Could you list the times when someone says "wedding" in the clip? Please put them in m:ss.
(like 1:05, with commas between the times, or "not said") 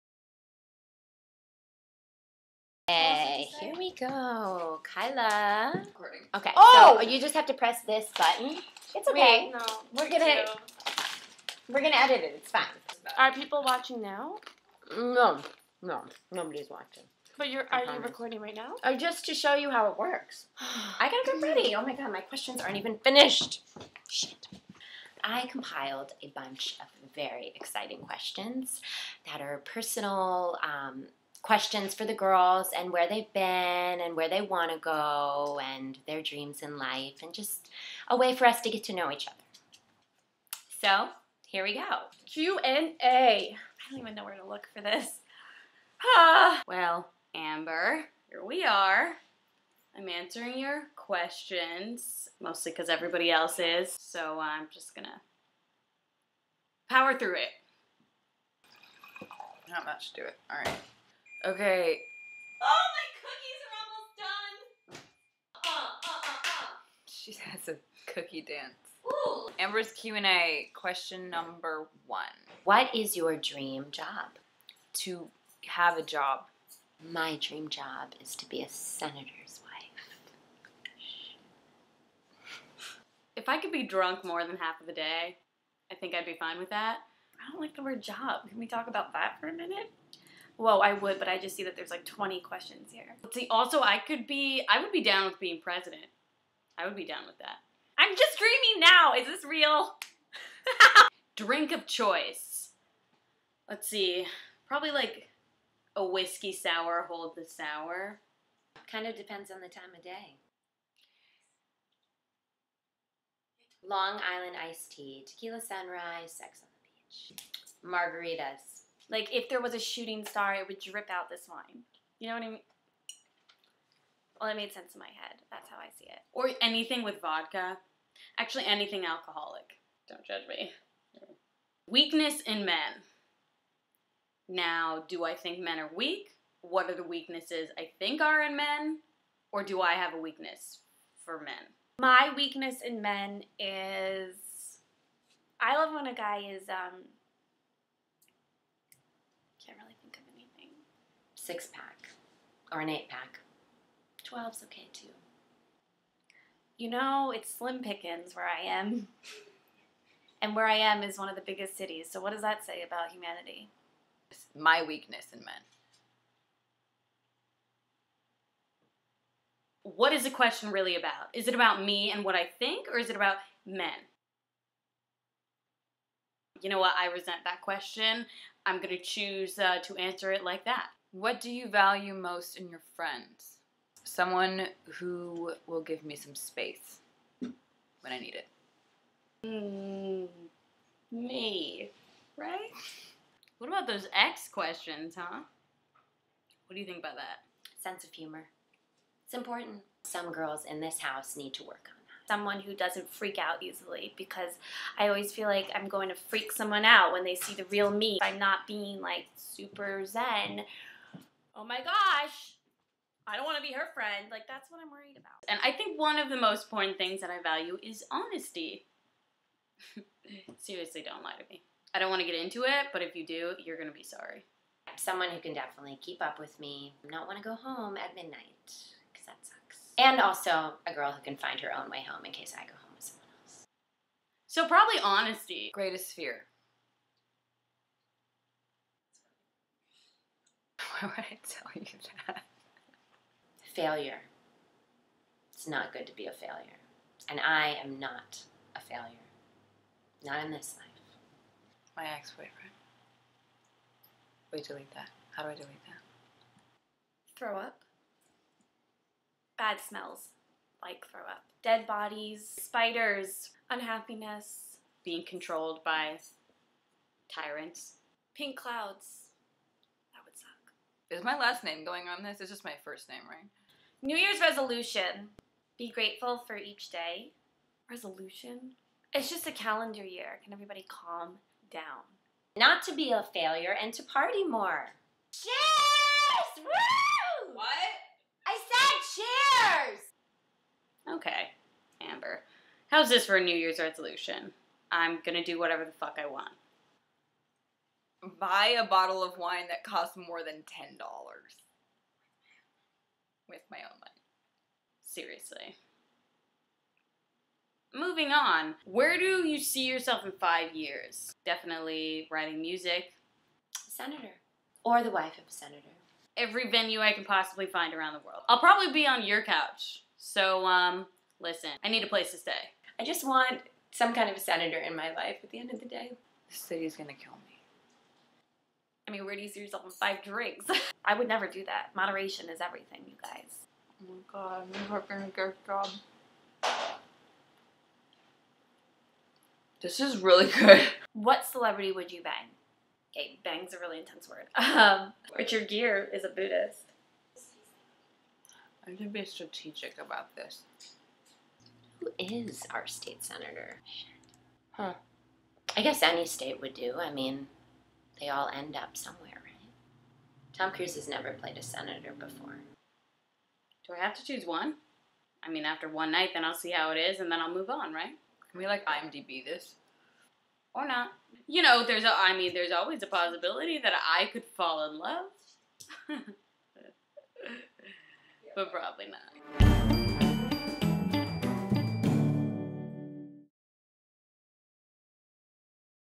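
not said.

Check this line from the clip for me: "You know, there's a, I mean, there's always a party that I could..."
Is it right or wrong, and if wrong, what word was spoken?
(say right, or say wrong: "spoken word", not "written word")
wrong: "possibility", not "party".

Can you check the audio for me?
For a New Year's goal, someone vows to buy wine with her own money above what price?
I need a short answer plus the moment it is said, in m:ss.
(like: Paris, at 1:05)
$10, at 5:00.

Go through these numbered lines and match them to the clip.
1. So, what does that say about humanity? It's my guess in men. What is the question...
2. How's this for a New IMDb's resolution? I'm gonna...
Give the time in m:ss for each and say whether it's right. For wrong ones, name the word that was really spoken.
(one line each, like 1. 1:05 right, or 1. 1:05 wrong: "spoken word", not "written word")
1. 2:42 wrong: "weakness", not "guess"
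2. 4:52 wrong: "Year", not "IMDb".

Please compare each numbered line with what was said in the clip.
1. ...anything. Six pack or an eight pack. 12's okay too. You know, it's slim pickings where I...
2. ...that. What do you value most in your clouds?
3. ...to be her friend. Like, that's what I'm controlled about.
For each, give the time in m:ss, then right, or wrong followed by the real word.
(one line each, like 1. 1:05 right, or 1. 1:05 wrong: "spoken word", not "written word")
1. 2:30 right
2. 3:00 wrong: "friends", not "clouds"
3. 3:33 wrong: "worried", not "controlled".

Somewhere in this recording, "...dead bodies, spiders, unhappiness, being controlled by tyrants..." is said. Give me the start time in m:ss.
4:21.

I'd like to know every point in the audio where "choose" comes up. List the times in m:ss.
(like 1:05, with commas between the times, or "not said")
2:58, 6:04.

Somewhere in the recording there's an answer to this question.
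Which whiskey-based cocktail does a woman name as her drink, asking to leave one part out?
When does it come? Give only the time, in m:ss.
1:46.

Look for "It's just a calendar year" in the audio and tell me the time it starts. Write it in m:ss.
4:39.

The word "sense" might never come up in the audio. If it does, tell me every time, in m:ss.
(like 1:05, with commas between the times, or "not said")
2:04, 3:17.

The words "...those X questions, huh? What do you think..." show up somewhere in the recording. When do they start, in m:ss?
3:13.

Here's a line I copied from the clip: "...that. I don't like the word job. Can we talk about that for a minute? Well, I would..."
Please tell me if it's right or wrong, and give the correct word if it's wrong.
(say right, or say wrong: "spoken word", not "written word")
right.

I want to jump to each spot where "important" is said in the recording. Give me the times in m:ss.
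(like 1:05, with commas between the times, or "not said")
3:19, 3:36.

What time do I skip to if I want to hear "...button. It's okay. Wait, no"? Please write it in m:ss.
0:08.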